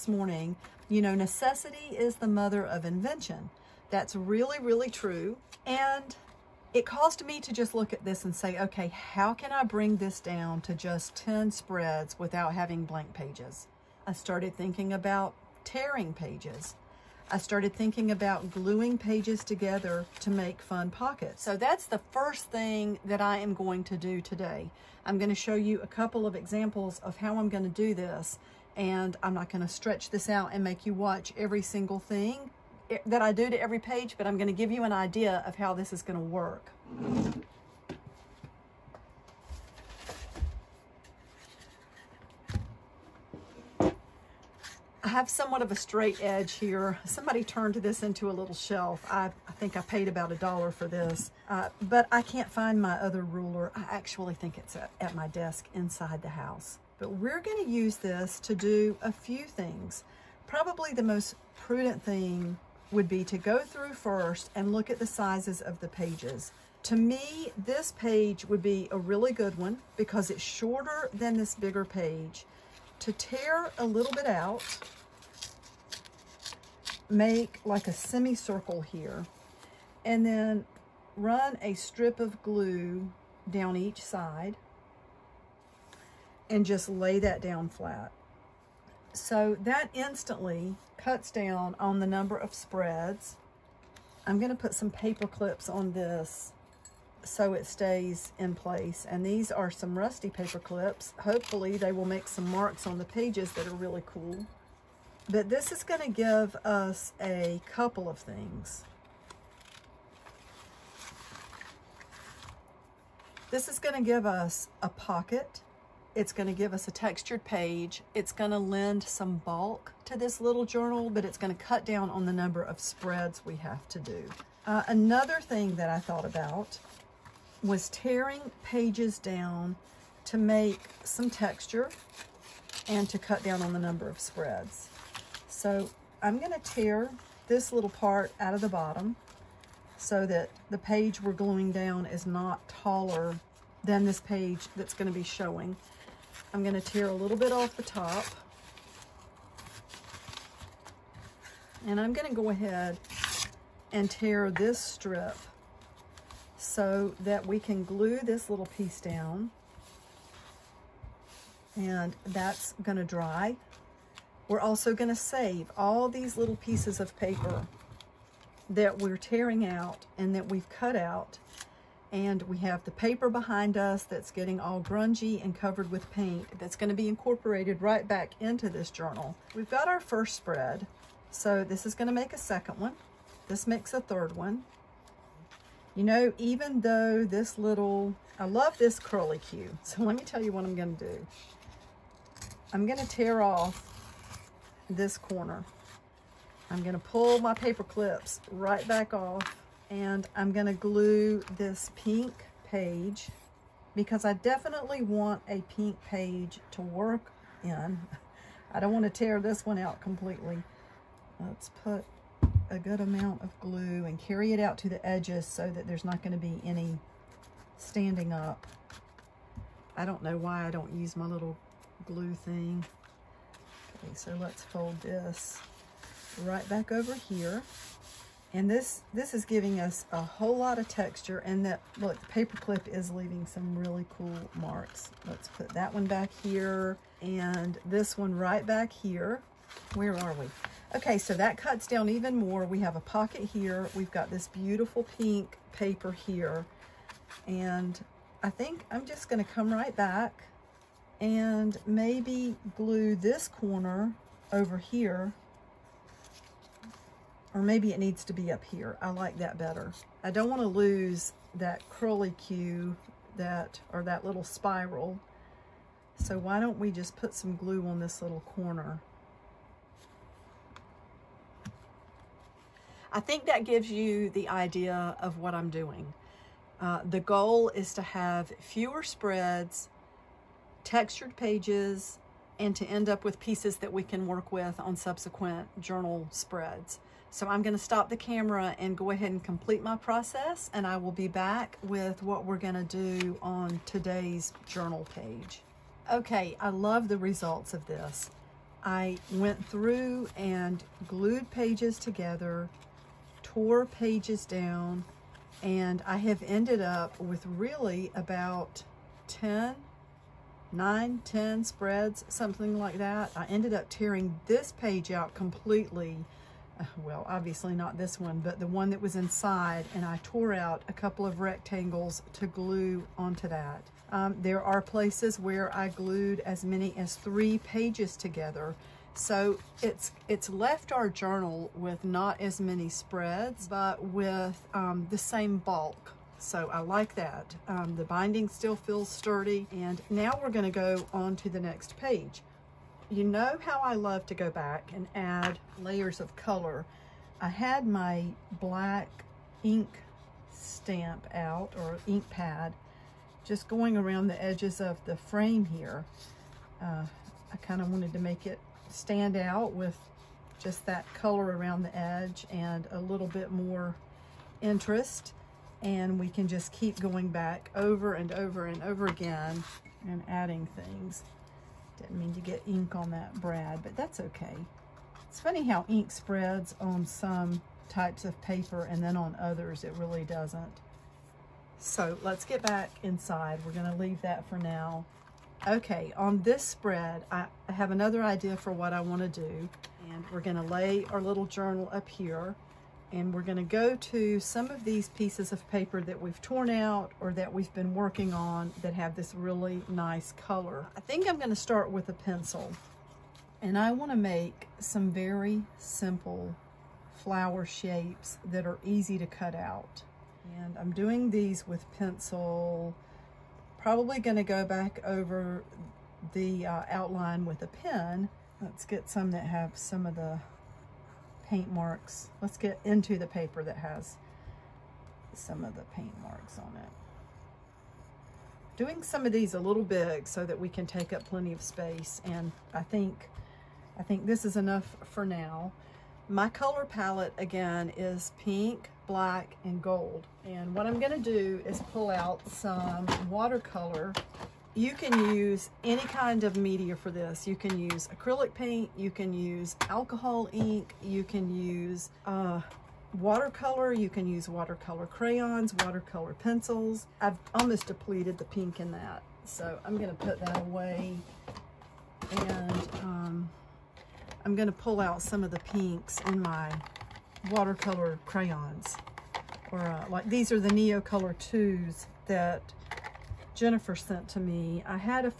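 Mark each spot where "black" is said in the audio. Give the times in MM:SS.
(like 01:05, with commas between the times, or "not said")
05:48, 07:19.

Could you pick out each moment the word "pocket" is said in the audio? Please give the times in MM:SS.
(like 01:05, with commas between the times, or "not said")
00:20, 01:54, 04:03.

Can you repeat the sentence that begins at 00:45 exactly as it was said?
have somewhat of a straight edge here.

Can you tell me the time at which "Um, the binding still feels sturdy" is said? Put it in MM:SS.
05:37.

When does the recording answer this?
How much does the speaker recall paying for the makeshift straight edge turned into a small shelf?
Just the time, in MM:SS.
00:50.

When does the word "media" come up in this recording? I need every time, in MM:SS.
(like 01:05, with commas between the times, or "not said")
07:26.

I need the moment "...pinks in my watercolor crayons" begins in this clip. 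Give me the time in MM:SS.
07:45.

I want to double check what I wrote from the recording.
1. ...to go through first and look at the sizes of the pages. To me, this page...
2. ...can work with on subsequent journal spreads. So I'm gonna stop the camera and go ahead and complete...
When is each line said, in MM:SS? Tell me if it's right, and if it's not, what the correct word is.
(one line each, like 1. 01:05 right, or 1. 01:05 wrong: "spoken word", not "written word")
1. 01:03 right
2. 04:44 right.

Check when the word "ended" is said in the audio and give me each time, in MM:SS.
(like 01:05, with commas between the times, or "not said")
05:06, 05:13.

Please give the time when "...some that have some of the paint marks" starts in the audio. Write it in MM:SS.
06:59.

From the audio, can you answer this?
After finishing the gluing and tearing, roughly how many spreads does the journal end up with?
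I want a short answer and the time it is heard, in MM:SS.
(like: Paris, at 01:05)
10, at 05:11.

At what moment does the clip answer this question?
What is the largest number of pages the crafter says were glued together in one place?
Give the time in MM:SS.
05:27.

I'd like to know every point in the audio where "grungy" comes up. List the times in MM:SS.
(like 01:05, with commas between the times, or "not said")
02:54.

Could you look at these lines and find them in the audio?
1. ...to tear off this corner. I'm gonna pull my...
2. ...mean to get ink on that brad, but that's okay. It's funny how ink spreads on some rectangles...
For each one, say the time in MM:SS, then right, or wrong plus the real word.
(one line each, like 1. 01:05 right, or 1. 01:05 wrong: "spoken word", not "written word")
1. 03:12 right
2. 06:12 wrong: "types", not "rectangles".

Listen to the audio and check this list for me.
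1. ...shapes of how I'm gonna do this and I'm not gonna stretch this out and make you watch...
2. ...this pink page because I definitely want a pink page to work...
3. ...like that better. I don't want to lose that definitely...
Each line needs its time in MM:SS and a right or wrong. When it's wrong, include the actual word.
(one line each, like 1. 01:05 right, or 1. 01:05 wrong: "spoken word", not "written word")
1. 00:26 wrong: "examples", not "shapes"
2. 03:21 right
3. 04:19 wrong: "curly", not "definitely".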